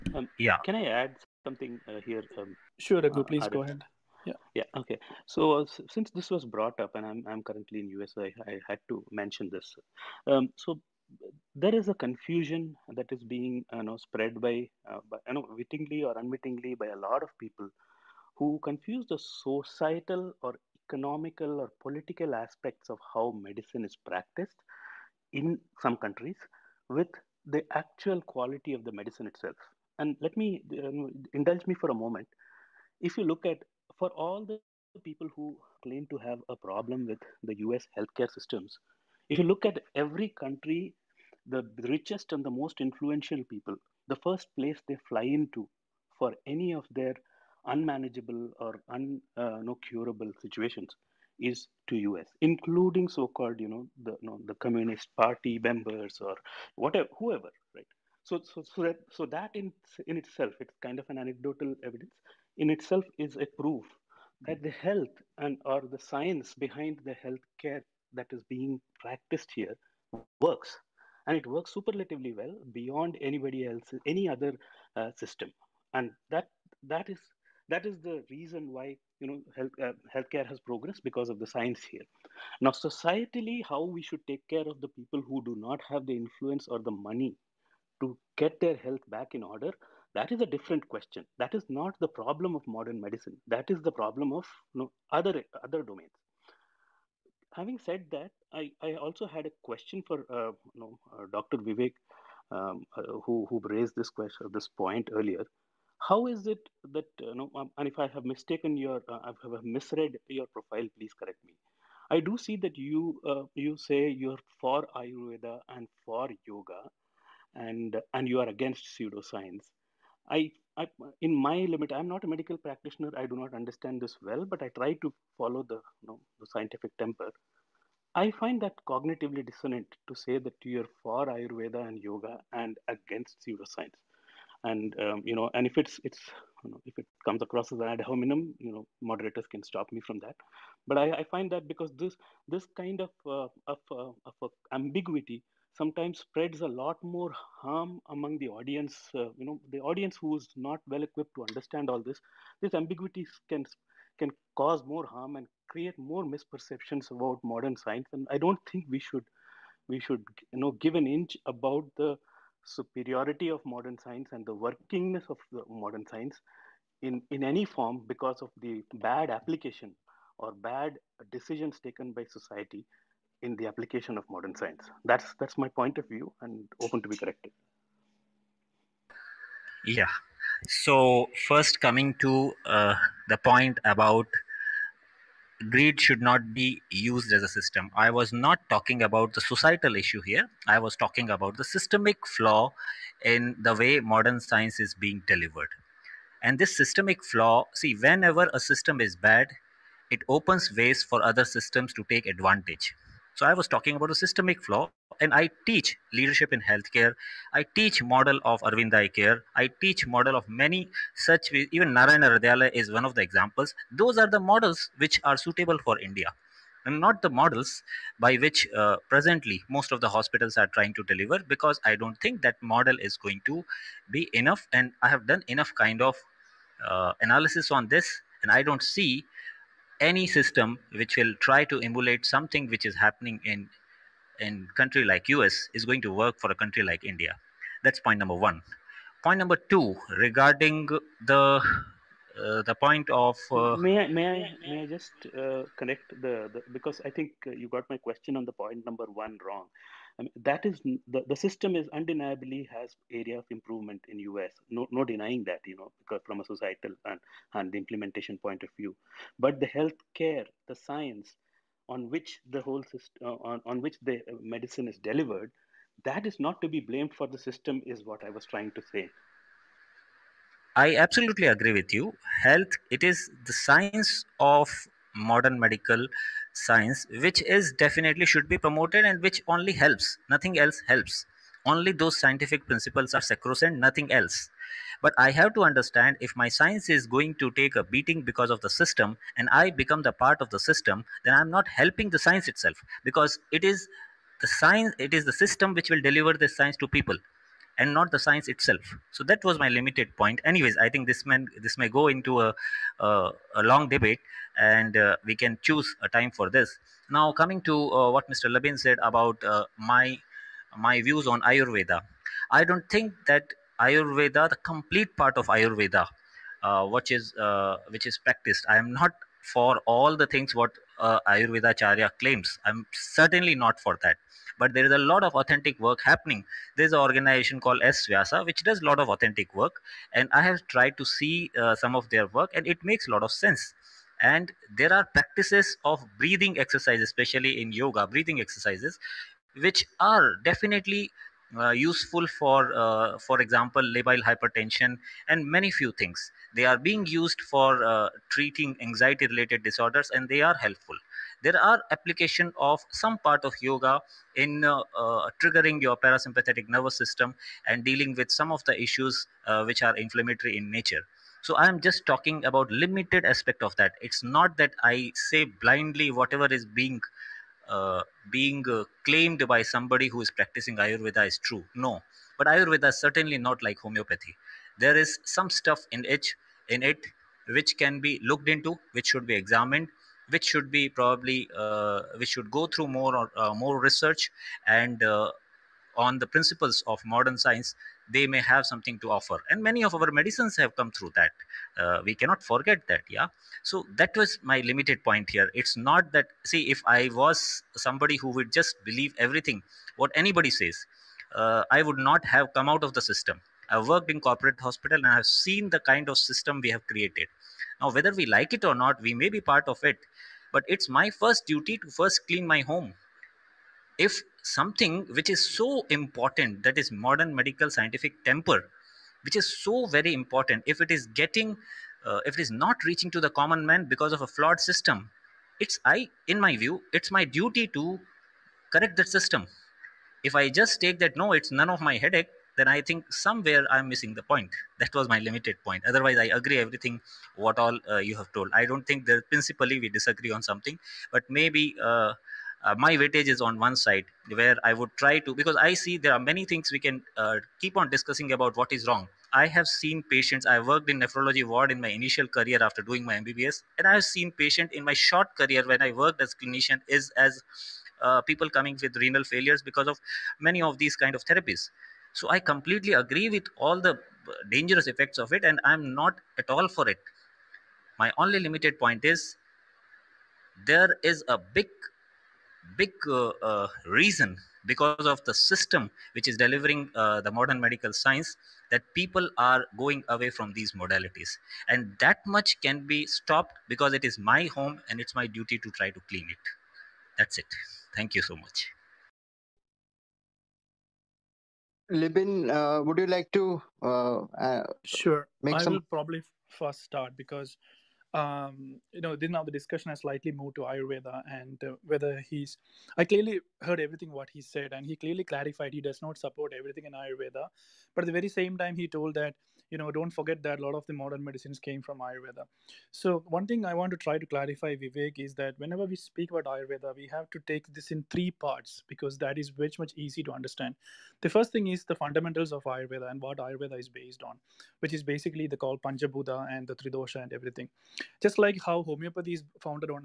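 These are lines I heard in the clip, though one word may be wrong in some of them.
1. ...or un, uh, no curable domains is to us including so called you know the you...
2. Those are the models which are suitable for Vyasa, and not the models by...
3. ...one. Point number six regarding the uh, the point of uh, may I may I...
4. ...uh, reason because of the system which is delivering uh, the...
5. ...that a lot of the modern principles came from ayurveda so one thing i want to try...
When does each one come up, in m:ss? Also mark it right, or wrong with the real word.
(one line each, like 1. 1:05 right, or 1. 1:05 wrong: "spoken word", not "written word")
1. 0:48 wrong: "situations", not "domains"
2. 3:33 wrong: "India", not "Vyasa"
3. 3:58 wrong: "two", not "six"
4. 7:53 right
5. 8:30 wrong: "medicines", not "principles".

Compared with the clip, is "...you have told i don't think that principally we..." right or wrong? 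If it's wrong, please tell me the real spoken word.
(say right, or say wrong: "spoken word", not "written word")
right.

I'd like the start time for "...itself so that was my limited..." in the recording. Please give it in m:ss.
4:58.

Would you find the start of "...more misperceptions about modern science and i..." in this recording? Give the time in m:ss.
2:35.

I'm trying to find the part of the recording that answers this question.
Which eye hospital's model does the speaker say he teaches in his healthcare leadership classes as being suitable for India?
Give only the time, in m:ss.
3:28.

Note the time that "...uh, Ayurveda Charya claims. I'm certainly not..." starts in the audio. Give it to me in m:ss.
5:20.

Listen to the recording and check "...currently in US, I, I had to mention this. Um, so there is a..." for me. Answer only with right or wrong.
right.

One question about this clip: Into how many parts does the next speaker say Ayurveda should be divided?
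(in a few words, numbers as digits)
3.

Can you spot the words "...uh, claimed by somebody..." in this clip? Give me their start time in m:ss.
6:08.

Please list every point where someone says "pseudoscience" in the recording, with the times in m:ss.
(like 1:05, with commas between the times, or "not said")
1:58, 2:13.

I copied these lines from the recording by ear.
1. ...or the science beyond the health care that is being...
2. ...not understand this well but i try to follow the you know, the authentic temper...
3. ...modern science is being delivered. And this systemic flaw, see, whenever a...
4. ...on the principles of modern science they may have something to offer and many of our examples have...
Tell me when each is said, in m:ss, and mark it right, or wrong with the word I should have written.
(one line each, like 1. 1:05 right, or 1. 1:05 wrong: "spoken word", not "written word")
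1. 1:05 wrong: "behind", not "beyond"
2. 2:03 wrong: "scientific", not "authentic"
3. 3:13 right
4. 6:25 wrong: "medicines", not "examples".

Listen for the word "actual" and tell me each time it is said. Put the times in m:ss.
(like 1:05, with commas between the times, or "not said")
0:27.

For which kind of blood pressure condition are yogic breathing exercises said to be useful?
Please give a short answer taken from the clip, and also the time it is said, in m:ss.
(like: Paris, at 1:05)
labile hypertension, at 5:43.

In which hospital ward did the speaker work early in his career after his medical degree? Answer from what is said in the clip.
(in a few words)
nephrology ward.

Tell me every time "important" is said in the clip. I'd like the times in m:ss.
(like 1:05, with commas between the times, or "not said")
6:55, 7:00.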